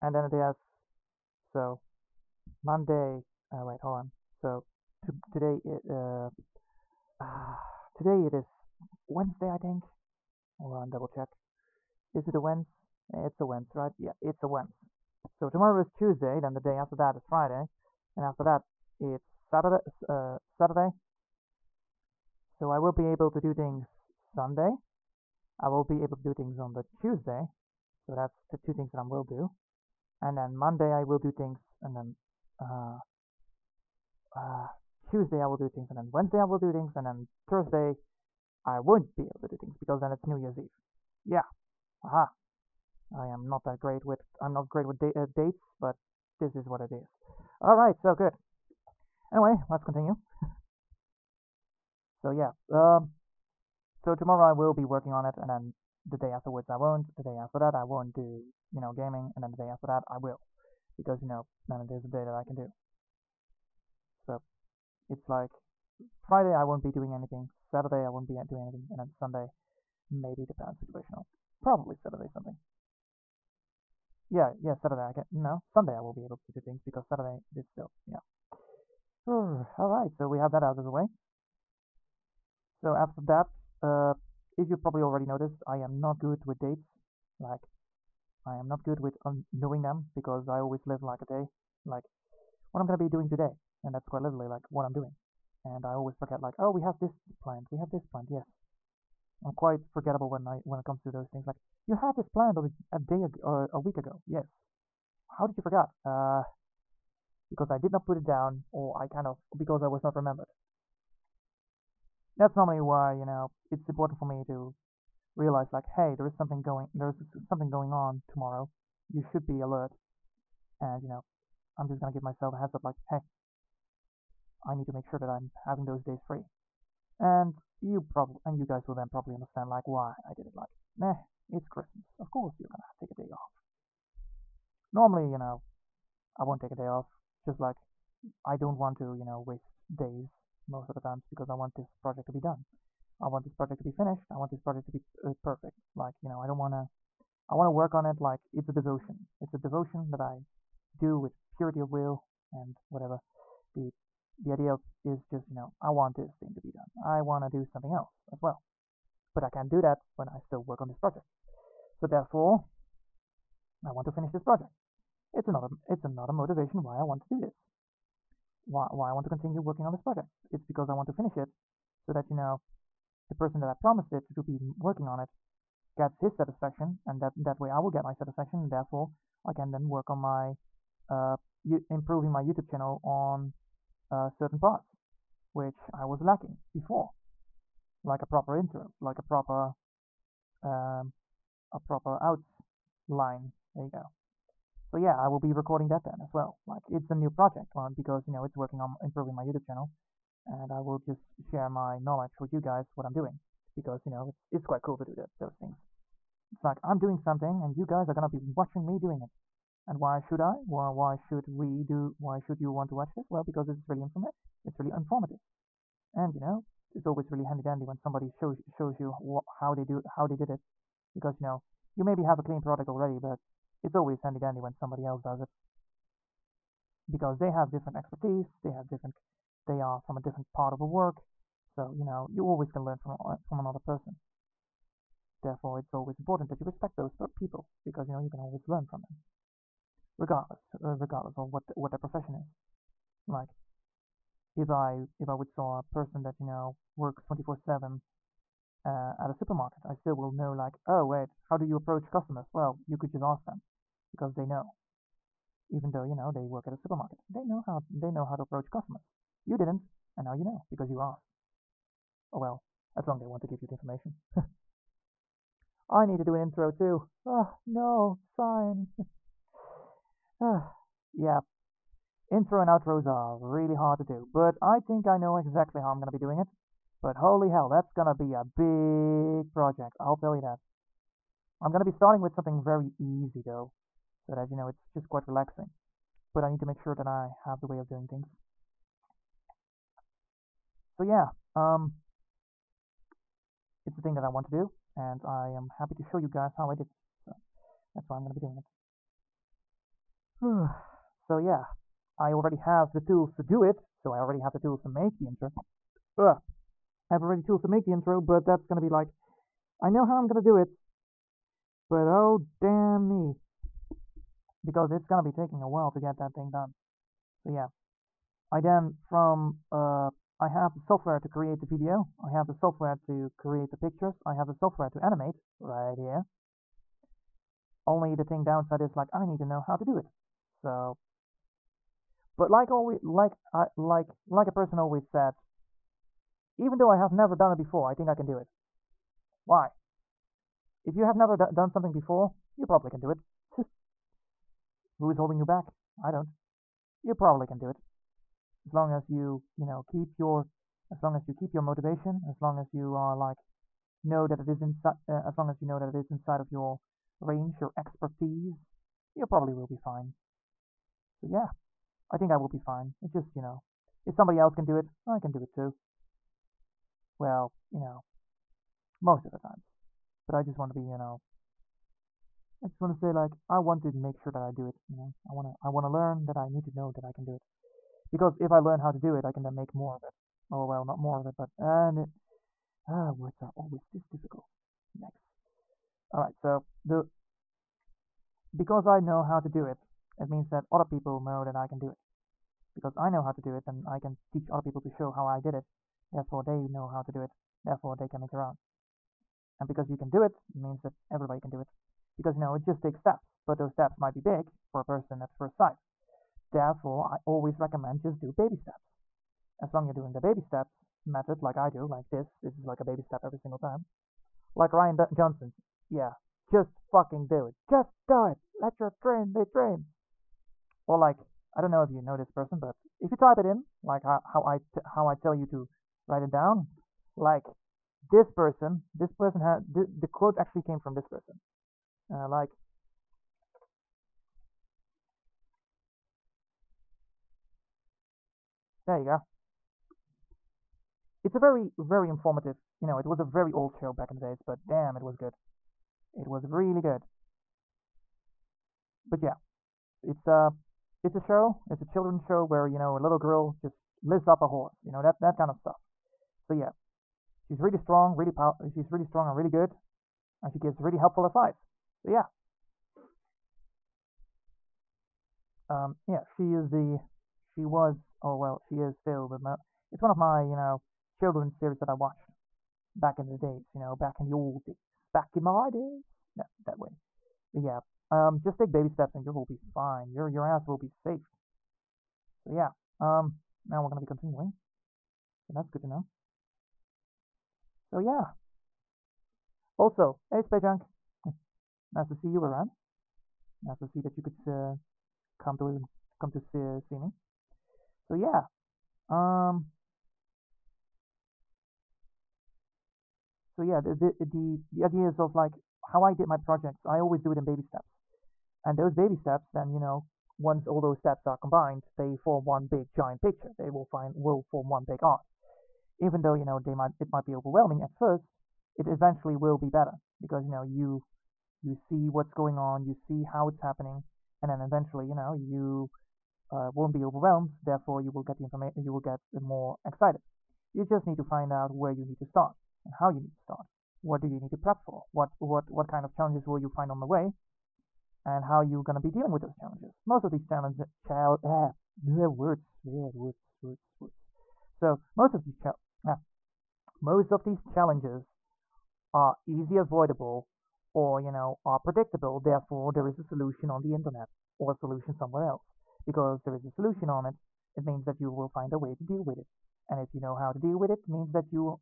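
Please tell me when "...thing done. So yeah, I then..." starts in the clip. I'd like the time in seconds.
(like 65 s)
316 s.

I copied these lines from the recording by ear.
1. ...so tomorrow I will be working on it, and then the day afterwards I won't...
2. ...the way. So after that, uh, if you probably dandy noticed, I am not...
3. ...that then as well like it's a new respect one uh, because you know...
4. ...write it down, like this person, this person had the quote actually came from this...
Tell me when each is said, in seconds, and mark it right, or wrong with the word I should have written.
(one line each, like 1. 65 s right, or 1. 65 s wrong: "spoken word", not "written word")
1. 53 s right
2. 80 s wrong: "already", not "dandy"
3. 195 s wrong: "project", not "respect"
4. 426 s right.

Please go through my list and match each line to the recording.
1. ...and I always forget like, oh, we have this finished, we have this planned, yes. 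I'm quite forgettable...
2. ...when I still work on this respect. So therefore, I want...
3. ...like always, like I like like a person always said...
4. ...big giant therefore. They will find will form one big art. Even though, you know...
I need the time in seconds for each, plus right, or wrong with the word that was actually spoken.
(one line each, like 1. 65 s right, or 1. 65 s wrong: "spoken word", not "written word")
1. 95 s wrong: "planned", not "finished"
2. 160 s wrong: "project", not "respect"
3. 332 s right
4. 512 s wrong: "picture", not "therefore".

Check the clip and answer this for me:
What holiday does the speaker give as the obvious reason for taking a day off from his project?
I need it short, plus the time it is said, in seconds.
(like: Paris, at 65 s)
Christmas, at 131 s.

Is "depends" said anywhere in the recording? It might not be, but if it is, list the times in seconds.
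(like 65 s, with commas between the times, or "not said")
70 s.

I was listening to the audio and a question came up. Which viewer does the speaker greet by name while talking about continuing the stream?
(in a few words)
Spejunk.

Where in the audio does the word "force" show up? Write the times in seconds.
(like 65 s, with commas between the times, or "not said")
not said.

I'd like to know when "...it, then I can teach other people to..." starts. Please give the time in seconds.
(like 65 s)
393 s.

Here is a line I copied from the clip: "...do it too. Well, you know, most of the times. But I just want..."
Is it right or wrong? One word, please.
right.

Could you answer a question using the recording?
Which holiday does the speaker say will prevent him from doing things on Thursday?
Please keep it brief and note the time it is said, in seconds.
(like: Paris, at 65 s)
New Year's Eve, at 40 s.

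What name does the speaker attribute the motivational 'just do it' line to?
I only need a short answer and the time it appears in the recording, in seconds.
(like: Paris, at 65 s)
Ryan D Johnson, at 414 s.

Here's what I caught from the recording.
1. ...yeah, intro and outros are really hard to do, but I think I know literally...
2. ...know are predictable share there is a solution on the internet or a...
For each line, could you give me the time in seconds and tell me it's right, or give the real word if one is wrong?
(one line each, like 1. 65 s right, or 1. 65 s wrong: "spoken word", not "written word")
1. 271 s wrong: "exactly", not "literally"
2. 551 s wrong: "therefore", not "share".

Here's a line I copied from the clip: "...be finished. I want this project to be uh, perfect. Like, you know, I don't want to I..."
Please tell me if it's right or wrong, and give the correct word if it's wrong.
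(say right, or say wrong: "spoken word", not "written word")
right.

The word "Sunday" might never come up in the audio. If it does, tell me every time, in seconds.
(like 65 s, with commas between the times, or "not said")
24 s, 69 s, 75 s.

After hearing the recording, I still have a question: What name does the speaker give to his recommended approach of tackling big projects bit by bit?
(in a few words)
baby steps method.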